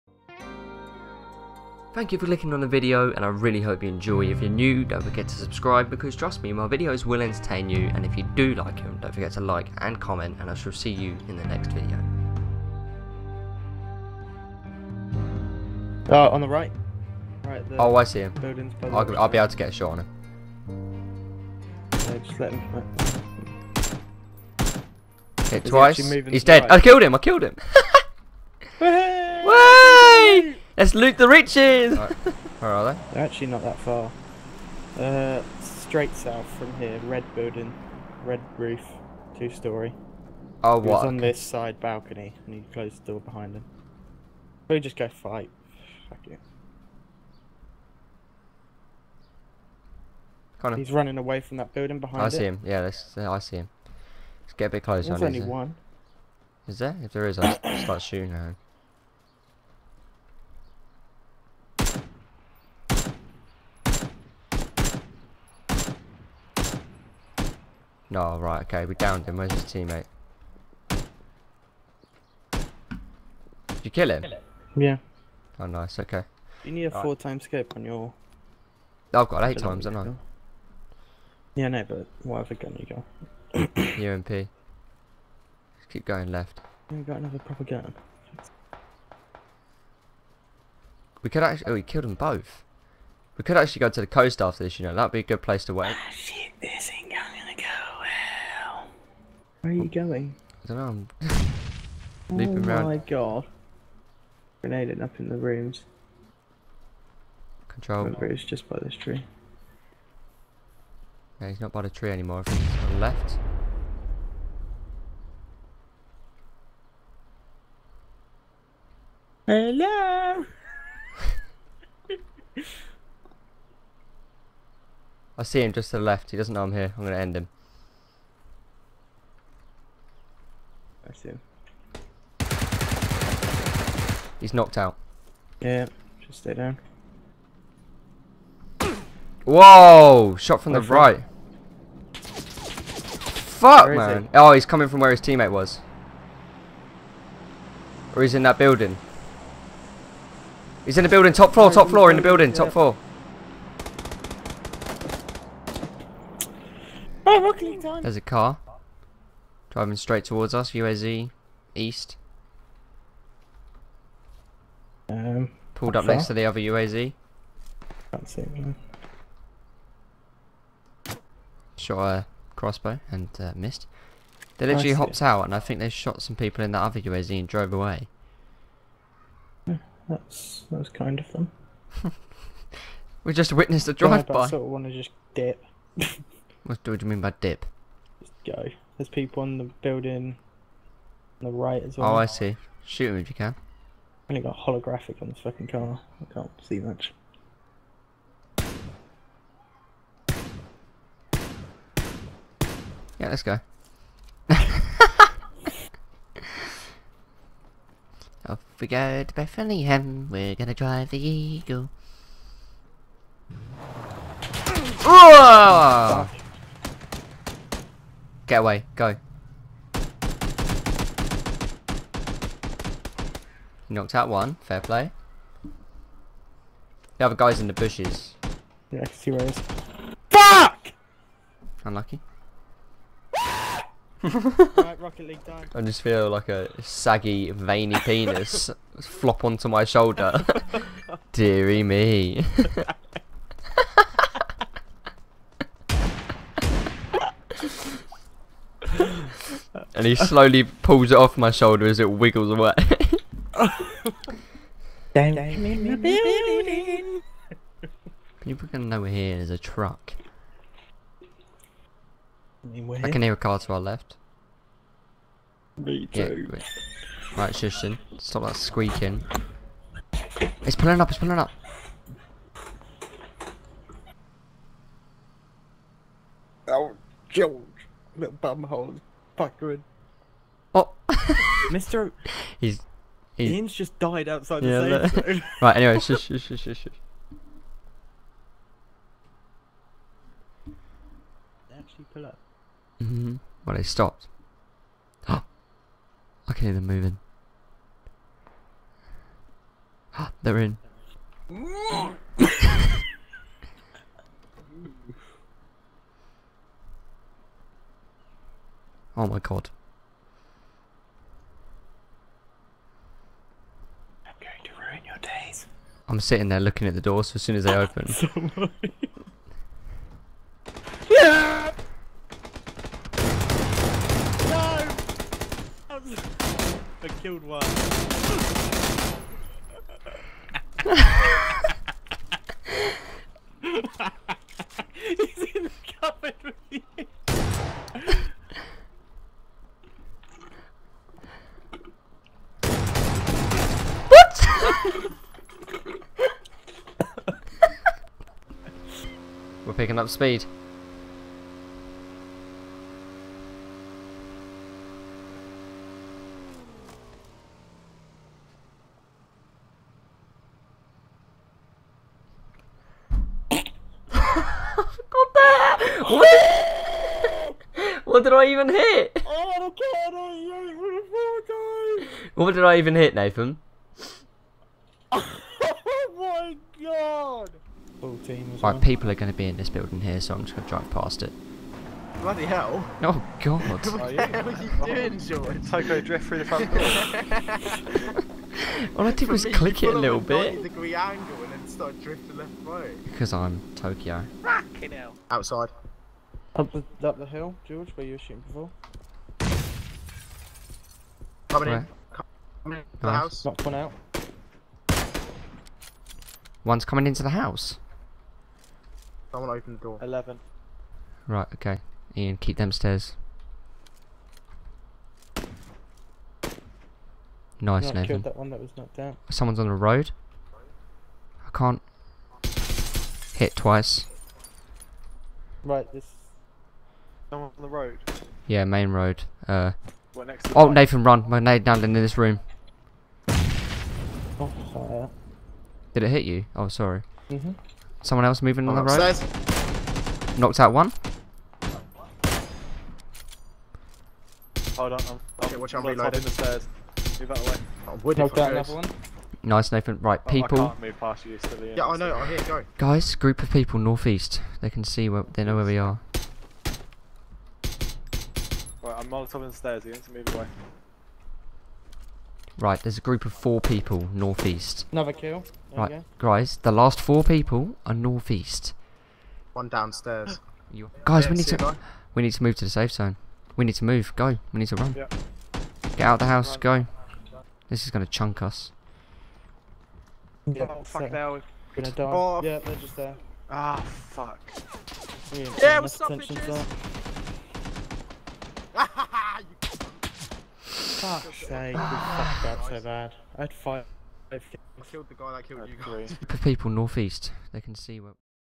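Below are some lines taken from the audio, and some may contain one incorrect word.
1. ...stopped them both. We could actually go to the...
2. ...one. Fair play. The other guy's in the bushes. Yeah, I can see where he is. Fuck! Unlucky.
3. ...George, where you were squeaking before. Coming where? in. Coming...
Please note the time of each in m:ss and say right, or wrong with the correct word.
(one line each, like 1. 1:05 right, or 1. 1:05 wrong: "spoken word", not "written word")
1. 1:31 wrong: "killed", not "stopped"
2. 3:44 right
3. 6:37 wrong: "shooting", not "squeaking".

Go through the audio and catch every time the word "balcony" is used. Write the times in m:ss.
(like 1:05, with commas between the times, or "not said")
0:41.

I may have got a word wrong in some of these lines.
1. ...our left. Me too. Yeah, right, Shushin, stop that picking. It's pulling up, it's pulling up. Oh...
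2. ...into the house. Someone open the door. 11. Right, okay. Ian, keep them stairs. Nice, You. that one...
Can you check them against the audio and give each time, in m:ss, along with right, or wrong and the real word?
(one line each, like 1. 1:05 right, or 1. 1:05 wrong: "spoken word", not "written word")
1. 4:23 wrong: "squeaking", not "picking"
2. 6:47 wrong: "Nathan", not "You".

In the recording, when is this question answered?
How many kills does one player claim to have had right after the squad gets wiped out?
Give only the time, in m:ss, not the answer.
8:13.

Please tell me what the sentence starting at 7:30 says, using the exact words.
I can't move past you, Yeah, I know.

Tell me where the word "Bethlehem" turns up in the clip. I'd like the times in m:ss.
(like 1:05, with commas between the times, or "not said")
3:29.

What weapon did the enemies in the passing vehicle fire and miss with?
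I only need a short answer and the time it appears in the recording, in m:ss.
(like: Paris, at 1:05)
Crossbow, at 2:52.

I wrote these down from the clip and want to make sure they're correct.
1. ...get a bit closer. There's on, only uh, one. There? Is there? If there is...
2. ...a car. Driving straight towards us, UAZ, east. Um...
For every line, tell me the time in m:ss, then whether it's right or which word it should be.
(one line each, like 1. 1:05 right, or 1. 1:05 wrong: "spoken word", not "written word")
1. 0:54 right
2. 2:38 right.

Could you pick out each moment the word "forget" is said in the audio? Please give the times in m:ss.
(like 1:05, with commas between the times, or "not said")
0:05, 0:09.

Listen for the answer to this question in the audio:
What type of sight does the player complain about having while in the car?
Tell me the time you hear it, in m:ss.
3:14.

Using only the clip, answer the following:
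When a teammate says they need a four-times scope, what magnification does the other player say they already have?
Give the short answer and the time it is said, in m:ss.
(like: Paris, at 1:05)
8 times, at 1:19.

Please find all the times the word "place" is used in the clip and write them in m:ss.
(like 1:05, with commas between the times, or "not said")
1:35.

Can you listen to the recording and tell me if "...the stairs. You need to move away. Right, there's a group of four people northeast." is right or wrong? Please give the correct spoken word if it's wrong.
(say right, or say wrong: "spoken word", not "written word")
right.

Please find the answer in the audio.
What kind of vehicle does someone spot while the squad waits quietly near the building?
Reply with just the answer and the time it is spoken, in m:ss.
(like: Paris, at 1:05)
Truck, at 4:19.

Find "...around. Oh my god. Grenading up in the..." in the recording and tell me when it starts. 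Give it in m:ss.
1:42.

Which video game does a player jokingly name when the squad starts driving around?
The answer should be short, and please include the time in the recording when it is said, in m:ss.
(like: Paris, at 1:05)
Rocket League, at 3:54.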